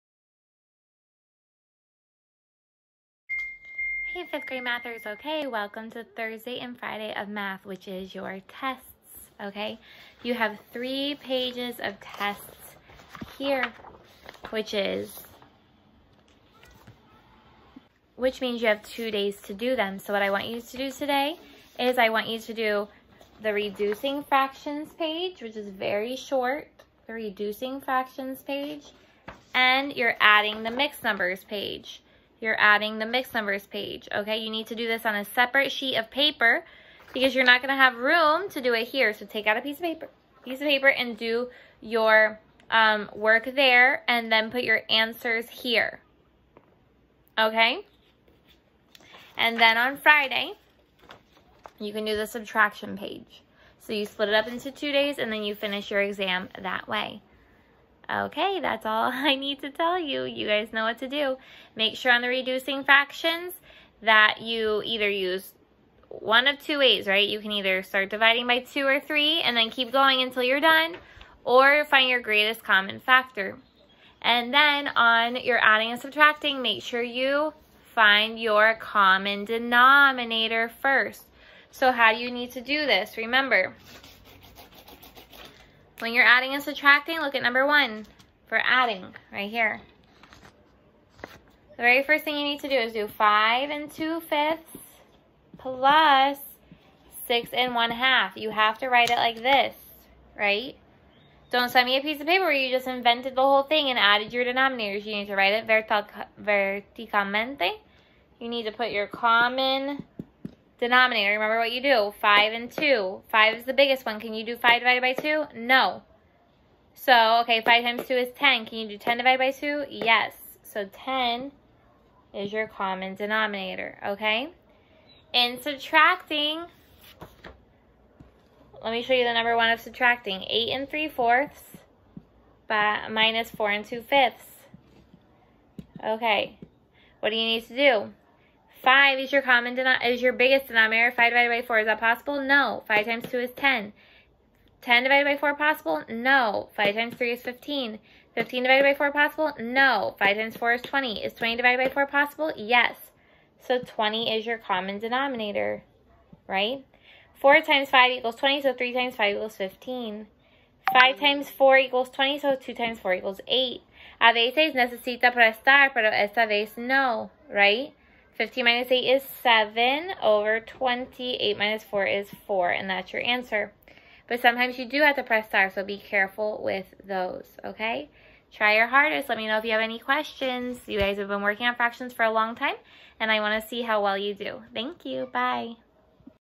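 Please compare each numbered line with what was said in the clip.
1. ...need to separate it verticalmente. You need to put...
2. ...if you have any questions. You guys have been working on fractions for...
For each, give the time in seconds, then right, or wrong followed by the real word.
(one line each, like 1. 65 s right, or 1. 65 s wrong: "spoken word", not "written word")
1. 105 s wrong: "write", not "separate"
2. 179 s right.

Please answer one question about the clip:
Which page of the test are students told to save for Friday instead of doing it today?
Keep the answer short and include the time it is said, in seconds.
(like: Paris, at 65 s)
subtraction page, at 52 s.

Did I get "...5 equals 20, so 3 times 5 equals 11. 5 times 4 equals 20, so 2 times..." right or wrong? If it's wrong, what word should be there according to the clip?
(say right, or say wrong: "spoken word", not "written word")
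wrong: "15", not "11".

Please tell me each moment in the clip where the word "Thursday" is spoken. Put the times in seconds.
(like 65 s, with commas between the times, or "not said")
6 s.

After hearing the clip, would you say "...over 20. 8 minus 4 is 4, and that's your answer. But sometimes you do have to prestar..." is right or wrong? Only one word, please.
right.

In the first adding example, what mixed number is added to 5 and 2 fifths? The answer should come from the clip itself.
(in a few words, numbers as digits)
6 and 1 half.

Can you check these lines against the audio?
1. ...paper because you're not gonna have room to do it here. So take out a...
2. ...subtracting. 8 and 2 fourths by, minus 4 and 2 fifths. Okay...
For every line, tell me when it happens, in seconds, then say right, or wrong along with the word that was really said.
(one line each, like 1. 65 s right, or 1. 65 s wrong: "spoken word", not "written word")
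1. 36 s right
2. 129 s wrong: "3", not "2".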